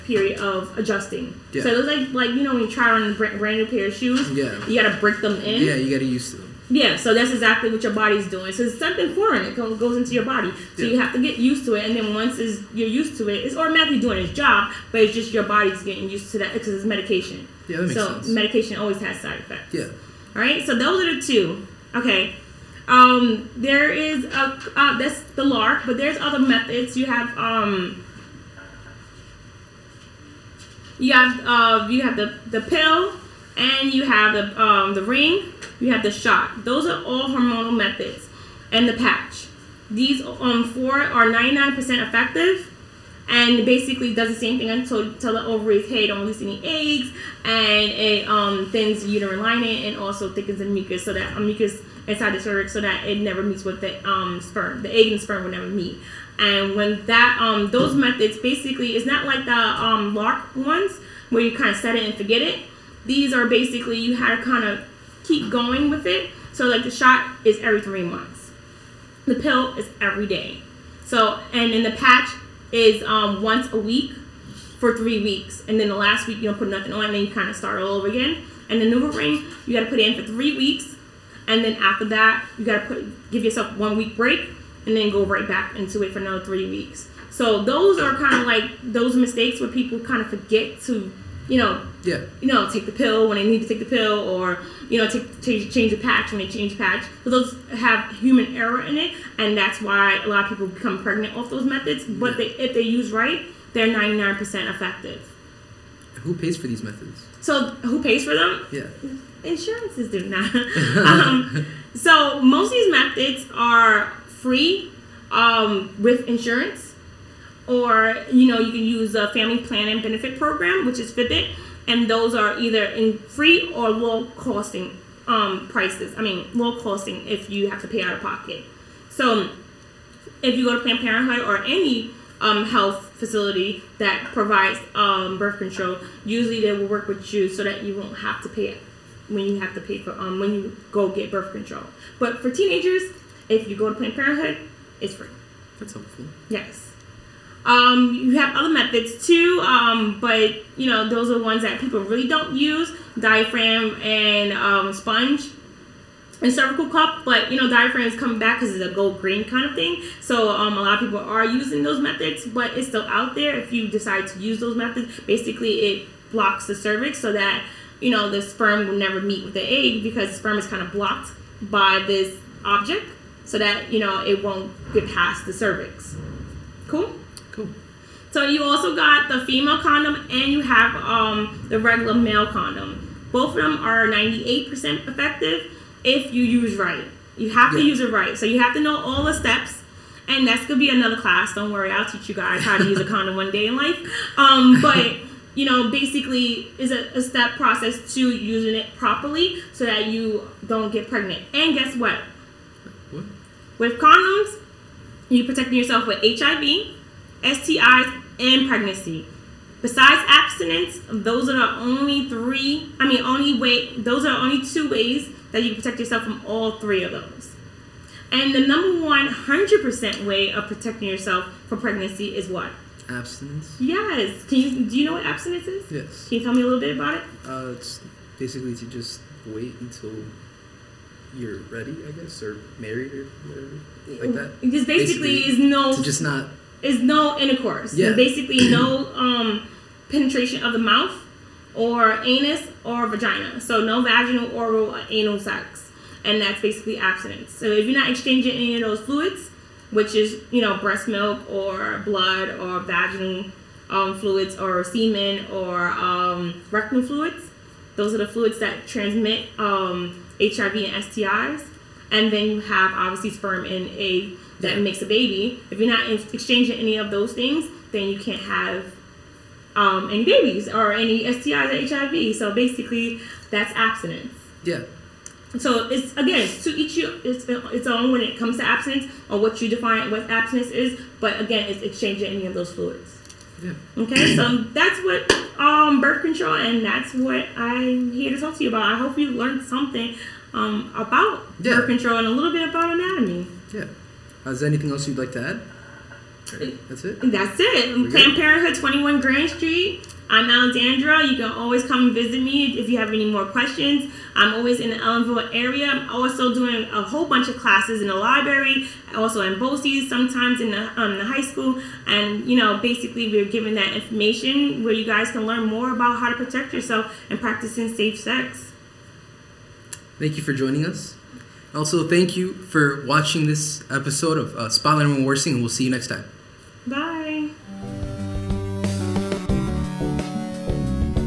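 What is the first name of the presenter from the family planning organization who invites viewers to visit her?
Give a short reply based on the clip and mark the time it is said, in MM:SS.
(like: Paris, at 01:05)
Alexandra, at 05:00.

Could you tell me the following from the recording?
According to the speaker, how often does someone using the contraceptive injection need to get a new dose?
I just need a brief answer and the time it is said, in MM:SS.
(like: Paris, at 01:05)
every three months, at 01:07.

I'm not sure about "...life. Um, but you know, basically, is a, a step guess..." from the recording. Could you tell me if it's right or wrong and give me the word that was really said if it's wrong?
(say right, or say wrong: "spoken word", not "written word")
wrong: "process", not "guess".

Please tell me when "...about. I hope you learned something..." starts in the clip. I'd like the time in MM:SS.
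04:48.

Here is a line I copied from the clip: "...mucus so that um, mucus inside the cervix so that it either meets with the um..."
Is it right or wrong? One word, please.
wrong.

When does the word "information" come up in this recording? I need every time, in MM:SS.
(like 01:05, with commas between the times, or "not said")
05:13.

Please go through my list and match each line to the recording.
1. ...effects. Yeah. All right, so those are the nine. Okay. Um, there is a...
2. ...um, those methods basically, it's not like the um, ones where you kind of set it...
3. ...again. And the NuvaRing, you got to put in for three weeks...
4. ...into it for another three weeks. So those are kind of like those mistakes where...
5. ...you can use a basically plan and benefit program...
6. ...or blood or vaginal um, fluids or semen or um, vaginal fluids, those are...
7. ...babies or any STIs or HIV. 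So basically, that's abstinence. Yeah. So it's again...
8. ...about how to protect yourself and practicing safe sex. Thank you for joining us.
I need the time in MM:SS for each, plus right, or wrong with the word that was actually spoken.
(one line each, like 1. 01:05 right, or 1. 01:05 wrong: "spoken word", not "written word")
1. 00:19 wrong: "two", not "nine"
2. 00:57 right
3. 01:18 right
4. 01:25 right
5. 01:58 wrong: "family", not "basically"
6. 04:11 wrong: "rectal", not "vaginal"
7. 04:30 right
8. 05:15 right.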